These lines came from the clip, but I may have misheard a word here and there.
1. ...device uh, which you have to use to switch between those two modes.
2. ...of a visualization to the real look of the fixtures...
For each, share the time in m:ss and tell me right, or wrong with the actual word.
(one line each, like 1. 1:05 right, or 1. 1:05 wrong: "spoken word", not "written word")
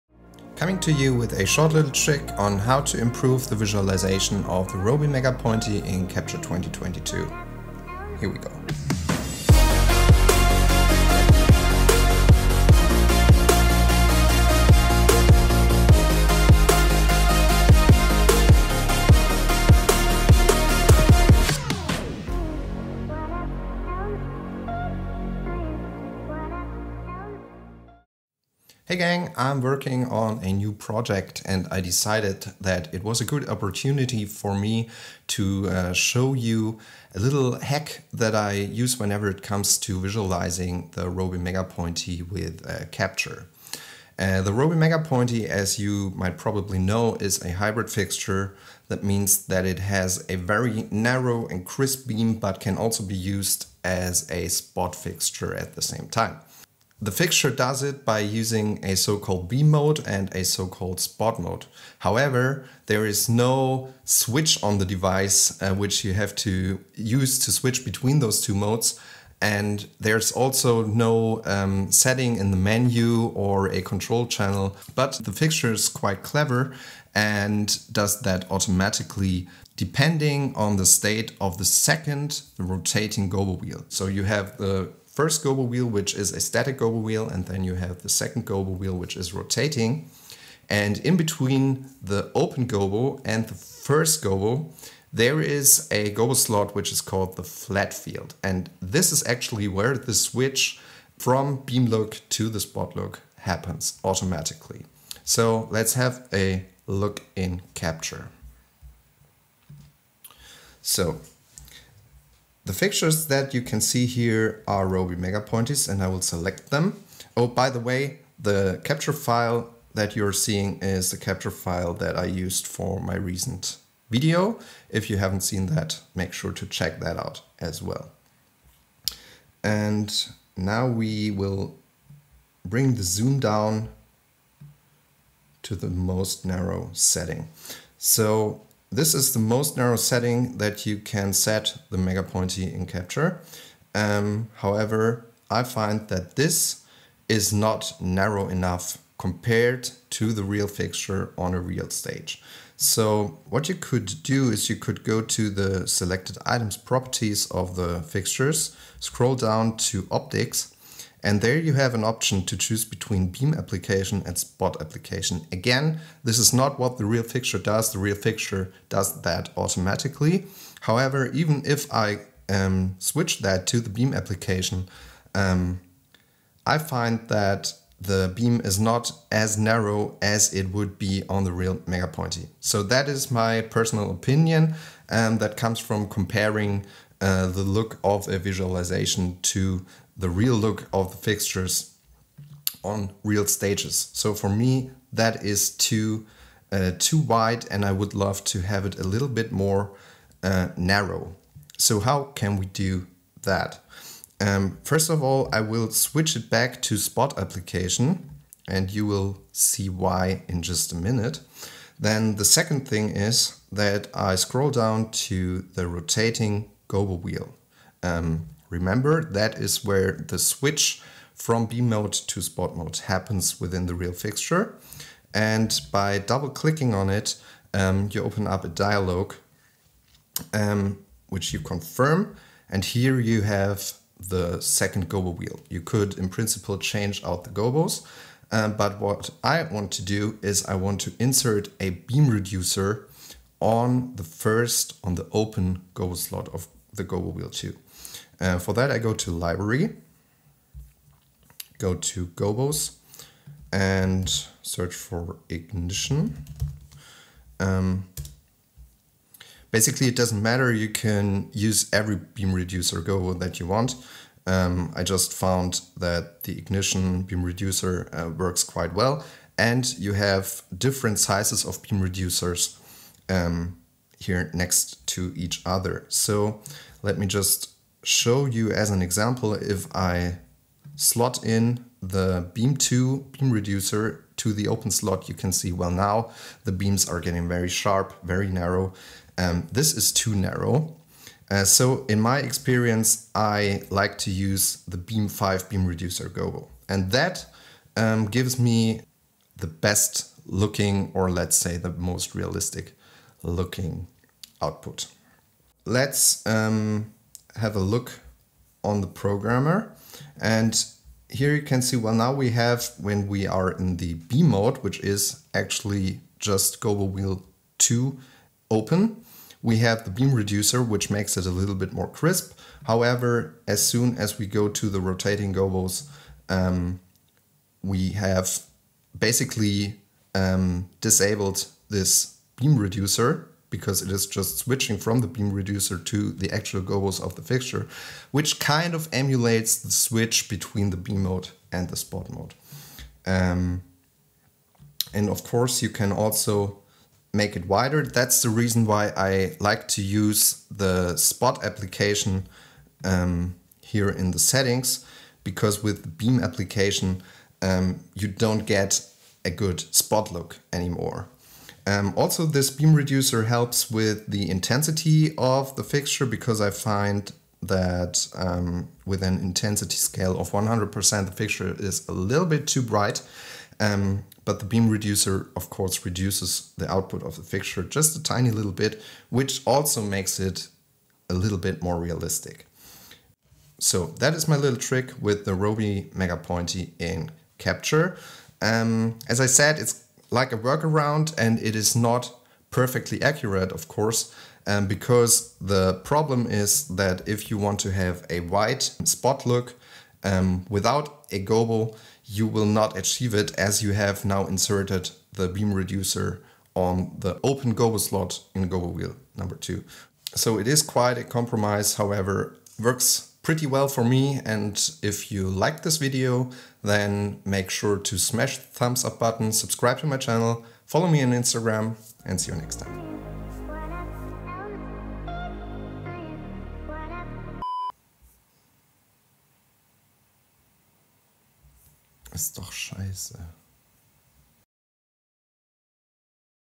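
1. 1:04 right
2. 3:08 right.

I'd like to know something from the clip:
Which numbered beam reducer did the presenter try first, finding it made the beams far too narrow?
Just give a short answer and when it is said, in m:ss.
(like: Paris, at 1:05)
beam 2, at 4:42.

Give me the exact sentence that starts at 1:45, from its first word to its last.
So let's have a look in Capture.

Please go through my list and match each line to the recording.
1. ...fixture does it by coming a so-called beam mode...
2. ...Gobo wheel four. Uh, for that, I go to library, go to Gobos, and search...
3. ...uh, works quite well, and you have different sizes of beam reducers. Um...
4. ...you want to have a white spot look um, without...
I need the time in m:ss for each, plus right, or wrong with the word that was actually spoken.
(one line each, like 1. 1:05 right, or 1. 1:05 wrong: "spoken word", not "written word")
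1. 0:57 wrong: "using", not "coming"
2. 4:07 wrong: "two", not "four"
3. 4:28 right
4. 6:37 right.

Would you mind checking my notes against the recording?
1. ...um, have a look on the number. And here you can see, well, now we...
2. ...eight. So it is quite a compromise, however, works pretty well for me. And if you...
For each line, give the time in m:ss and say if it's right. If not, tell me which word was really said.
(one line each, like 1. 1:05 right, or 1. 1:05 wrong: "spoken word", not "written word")
1. 5:06 wrong: "programmer", not "number"
2. 6:49 wrong: "two", not "eight".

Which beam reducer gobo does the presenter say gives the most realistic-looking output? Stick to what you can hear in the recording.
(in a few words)
beam 5.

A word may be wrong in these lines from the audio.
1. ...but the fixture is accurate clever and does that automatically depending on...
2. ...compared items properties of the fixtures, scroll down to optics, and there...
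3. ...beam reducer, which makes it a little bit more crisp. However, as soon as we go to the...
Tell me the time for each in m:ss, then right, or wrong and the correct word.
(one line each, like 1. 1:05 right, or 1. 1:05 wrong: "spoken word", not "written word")
1. 1:14 wrong: "quite", not "accurate"
2. 2:35 wrong: "selected", not "compared"
3. 5:20 right.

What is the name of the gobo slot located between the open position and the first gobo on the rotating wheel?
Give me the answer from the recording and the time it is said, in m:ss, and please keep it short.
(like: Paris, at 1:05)
flat field, at 1:37.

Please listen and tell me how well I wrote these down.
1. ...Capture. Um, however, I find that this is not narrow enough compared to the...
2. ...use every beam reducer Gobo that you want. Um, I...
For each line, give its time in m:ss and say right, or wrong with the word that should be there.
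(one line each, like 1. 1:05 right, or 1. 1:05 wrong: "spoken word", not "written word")
1. 2:22 right
2. 4:21 right.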